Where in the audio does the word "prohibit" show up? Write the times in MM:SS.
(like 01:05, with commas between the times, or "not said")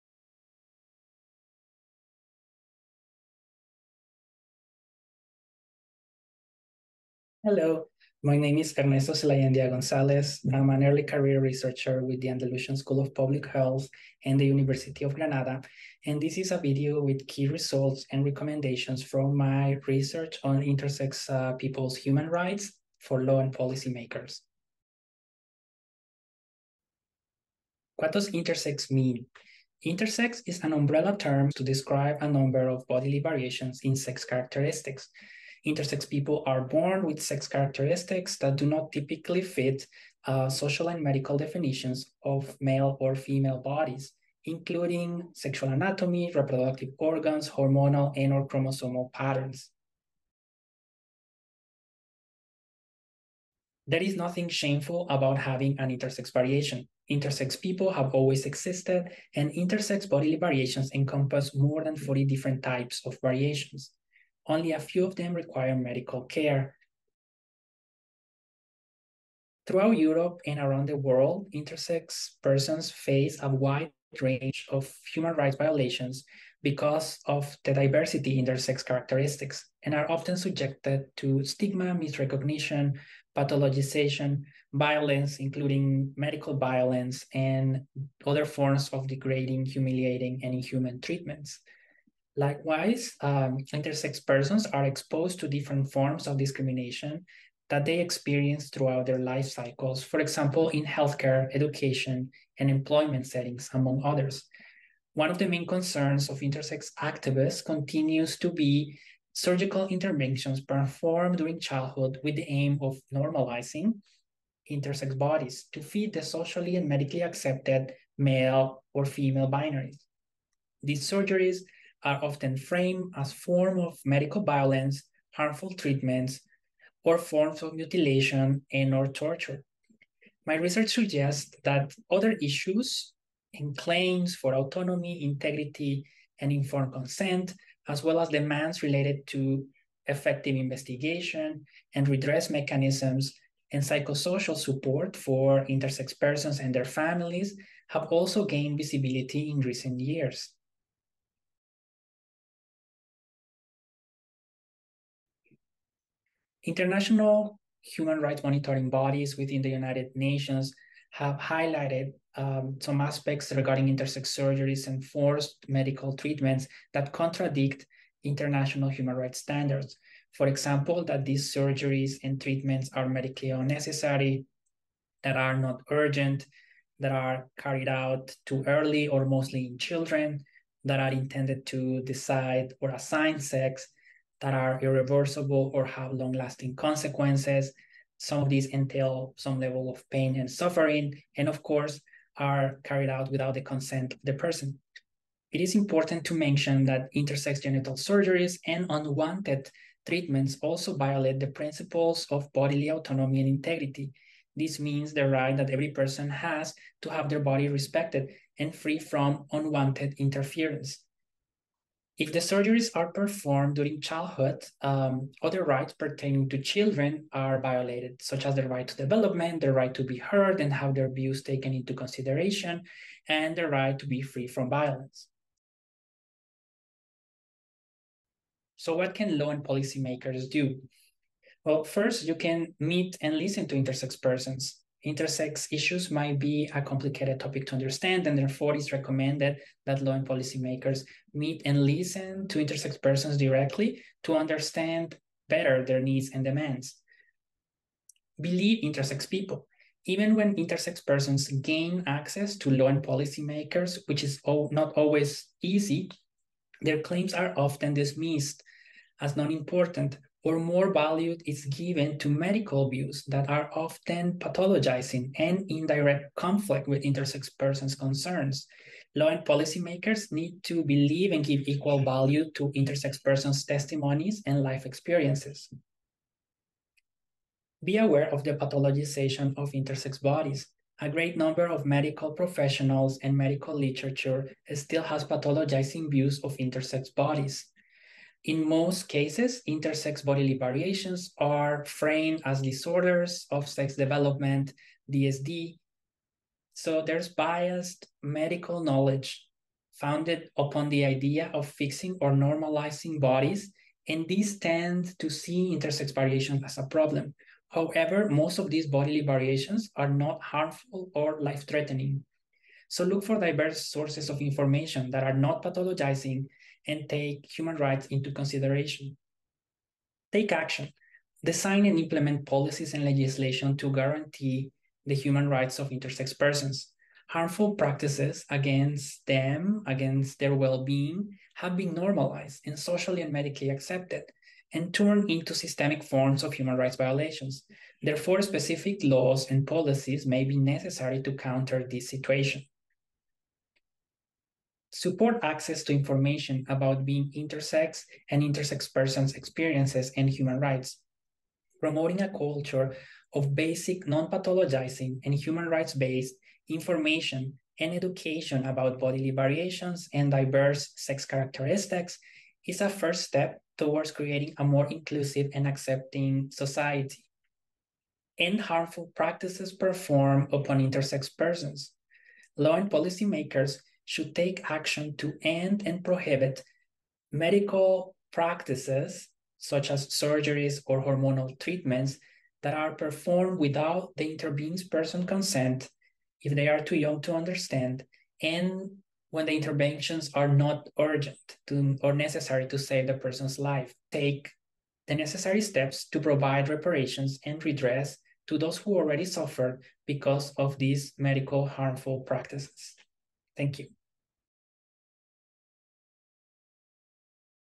06:16.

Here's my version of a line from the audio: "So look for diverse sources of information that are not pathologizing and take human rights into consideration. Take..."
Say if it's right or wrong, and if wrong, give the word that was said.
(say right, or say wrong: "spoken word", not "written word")
right.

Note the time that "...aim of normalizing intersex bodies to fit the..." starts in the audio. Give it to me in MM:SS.
01:52.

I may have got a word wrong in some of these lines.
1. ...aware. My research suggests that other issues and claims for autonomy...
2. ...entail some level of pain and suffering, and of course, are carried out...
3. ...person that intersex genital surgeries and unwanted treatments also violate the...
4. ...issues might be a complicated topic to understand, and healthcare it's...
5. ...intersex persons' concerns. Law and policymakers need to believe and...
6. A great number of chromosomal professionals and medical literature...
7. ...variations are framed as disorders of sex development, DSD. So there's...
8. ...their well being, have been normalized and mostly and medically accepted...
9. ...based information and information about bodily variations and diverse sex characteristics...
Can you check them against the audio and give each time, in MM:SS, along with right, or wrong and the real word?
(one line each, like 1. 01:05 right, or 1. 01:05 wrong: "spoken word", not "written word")
1. 02:09 wrong: "torture", not "aware"
2. 03:08 right
3. 03:16 wrong: "mention", not "person"
4. 03:55 wrong: "therefore", not "healthcare"
5. 04:27 right
6. 04:41 wrong: "medical", not "chromosomal"
7. 04:50 right
8. 05:30 wrong: "socially", not "mostly"
9. 05:55 wrong: "education", not "information".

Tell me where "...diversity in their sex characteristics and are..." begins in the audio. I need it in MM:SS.
01:17.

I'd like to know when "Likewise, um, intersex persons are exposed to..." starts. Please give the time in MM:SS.
01:32.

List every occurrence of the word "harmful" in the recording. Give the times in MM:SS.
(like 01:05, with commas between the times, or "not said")
02:05, 05:10, 05:27, 06:08, 06:41.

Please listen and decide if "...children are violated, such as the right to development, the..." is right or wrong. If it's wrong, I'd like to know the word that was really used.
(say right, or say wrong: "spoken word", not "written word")
right.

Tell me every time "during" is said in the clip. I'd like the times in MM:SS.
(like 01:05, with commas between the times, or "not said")
01:51, 03:33.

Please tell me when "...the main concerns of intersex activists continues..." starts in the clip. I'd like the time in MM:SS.
01:45.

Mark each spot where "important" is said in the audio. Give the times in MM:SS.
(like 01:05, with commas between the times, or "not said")
03:15, 04:19.